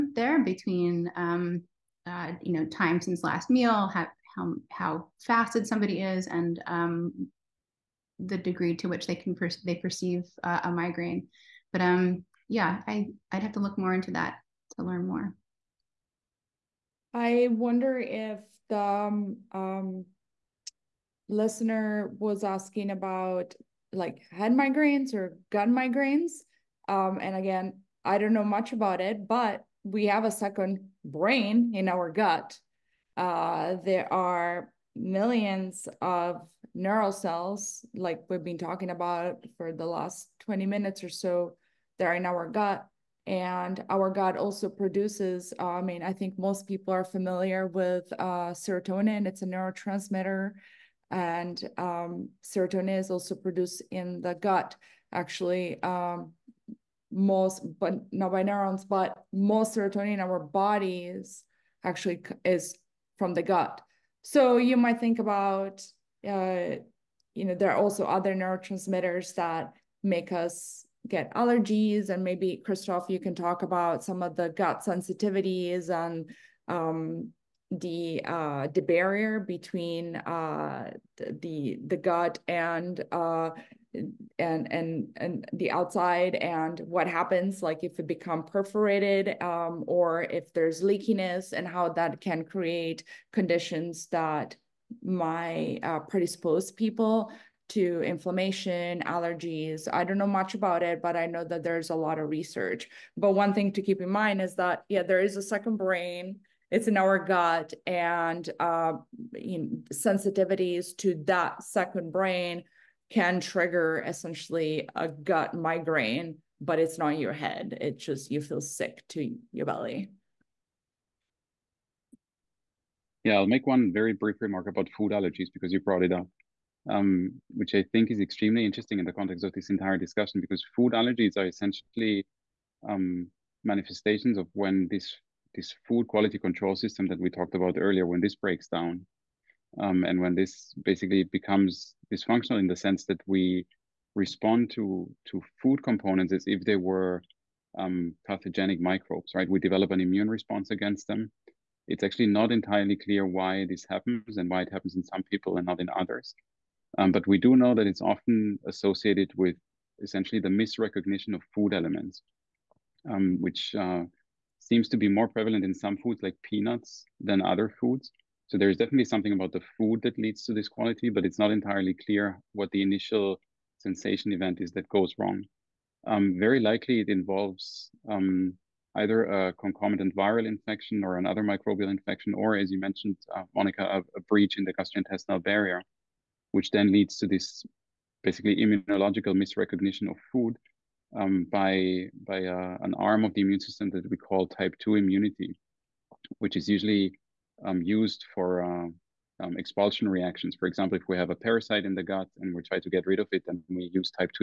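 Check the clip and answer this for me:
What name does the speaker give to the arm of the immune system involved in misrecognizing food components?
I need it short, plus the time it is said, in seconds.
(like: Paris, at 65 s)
type 2 immunity, at 194 s.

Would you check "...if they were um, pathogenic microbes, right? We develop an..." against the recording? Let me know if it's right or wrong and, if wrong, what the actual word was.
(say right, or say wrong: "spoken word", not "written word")
right.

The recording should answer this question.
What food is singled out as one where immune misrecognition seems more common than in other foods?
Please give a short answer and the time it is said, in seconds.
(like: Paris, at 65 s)
peanuts, at 166 s.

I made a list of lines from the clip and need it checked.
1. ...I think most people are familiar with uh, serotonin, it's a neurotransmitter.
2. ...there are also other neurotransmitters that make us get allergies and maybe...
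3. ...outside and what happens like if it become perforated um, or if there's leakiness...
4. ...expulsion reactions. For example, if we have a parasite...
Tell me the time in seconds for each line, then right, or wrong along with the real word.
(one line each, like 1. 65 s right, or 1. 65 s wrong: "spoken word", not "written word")
1. 46 s right
2. 67 s right
3. 85 s right
4. 199 s right.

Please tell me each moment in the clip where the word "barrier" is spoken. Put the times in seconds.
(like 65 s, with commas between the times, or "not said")
78 s, 185 s.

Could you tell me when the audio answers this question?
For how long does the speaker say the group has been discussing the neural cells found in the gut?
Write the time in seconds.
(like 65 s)
40 s.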